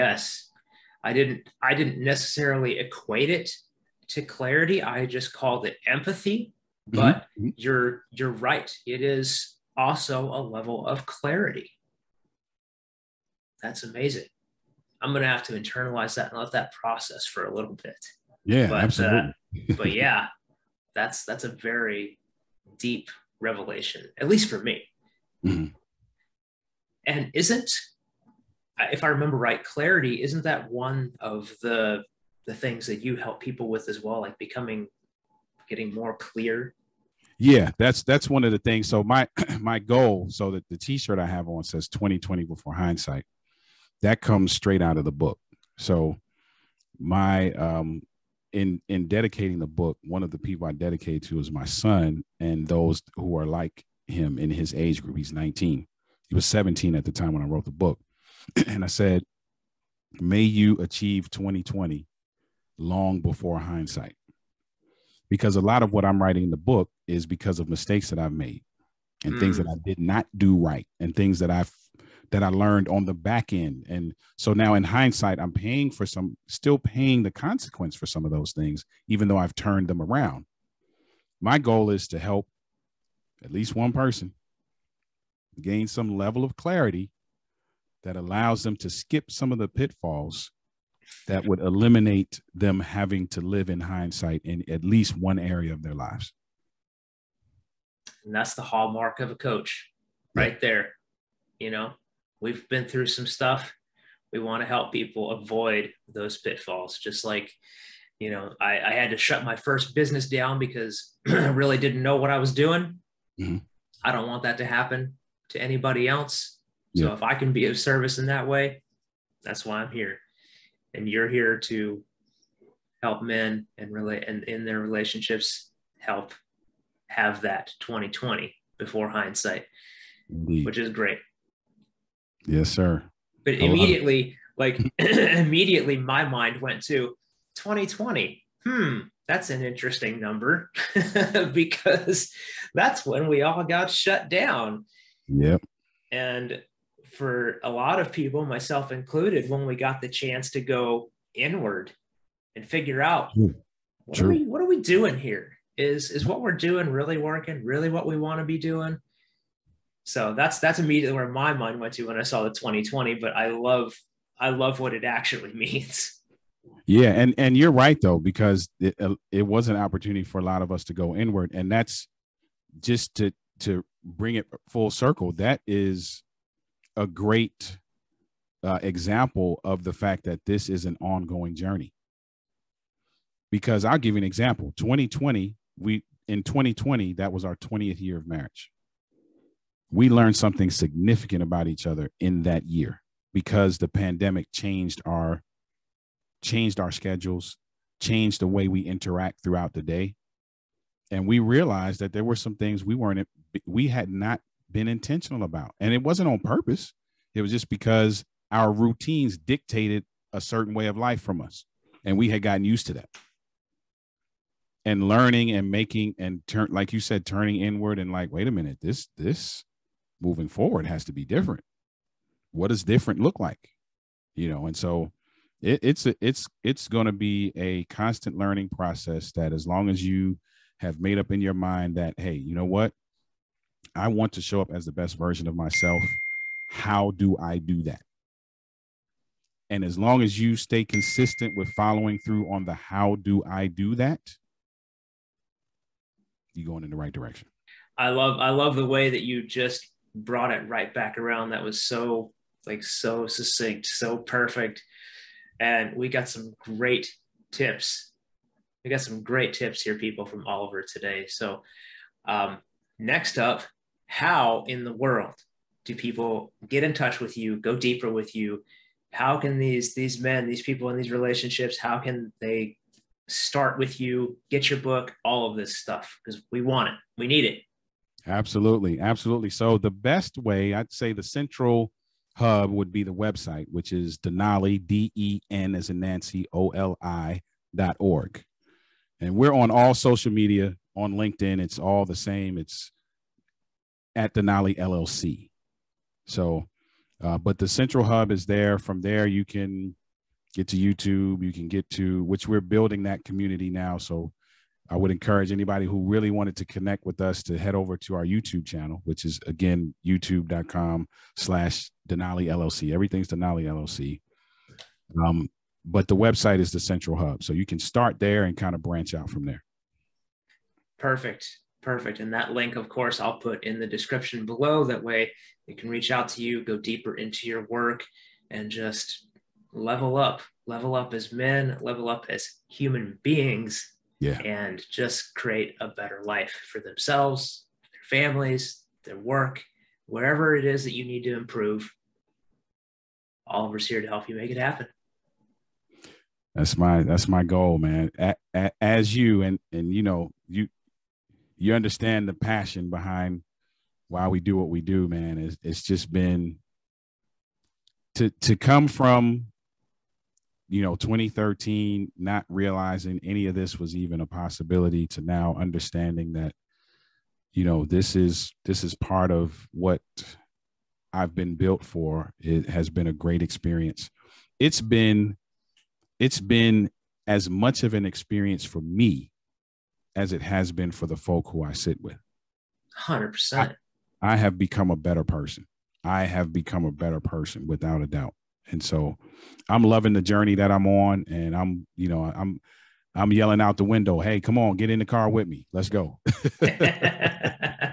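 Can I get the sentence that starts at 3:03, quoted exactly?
Because I'll give you an example.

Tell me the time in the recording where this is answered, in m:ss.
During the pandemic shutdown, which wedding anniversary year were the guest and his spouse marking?
3:07.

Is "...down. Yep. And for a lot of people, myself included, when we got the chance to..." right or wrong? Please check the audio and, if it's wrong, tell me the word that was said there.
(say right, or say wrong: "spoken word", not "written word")
right.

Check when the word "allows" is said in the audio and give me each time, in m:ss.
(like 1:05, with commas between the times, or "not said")
1:28.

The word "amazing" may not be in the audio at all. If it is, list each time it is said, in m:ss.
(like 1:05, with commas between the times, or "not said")
0:13.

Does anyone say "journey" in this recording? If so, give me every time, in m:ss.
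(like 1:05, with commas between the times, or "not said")
3:01, 6:30.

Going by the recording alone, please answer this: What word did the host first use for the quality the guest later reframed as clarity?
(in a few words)
empathy.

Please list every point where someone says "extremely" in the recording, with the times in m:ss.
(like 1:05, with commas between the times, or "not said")
not said.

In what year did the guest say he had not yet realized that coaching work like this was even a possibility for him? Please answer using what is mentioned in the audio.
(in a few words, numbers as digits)
2013.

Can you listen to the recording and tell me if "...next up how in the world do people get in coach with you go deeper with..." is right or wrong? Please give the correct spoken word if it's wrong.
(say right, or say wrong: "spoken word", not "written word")
wrong: "touch", not "coach".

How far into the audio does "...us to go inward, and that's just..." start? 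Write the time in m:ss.
2:50.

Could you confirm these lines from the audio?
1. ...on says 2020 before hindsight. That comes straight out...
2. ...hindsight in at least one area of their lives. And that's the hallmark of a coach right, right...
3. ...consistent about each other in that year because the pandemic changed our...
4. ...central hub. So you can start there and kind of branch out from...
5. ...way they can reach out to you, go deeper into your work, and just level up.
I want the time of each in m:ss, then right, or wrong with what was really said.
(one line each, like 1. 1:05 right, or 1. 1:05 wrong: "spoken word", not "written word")
1. 0:41 right
2. 1:33 right
3. 3:10 wrong: "significant", not "consistent"
4. 5:16 right
5. 5:25 right.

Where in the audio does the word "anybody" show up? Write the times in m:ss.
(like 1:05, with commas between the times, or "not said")
1:55, 5:05.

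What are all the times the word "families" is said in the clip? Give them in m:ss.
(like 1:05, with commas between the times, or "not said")
5:38.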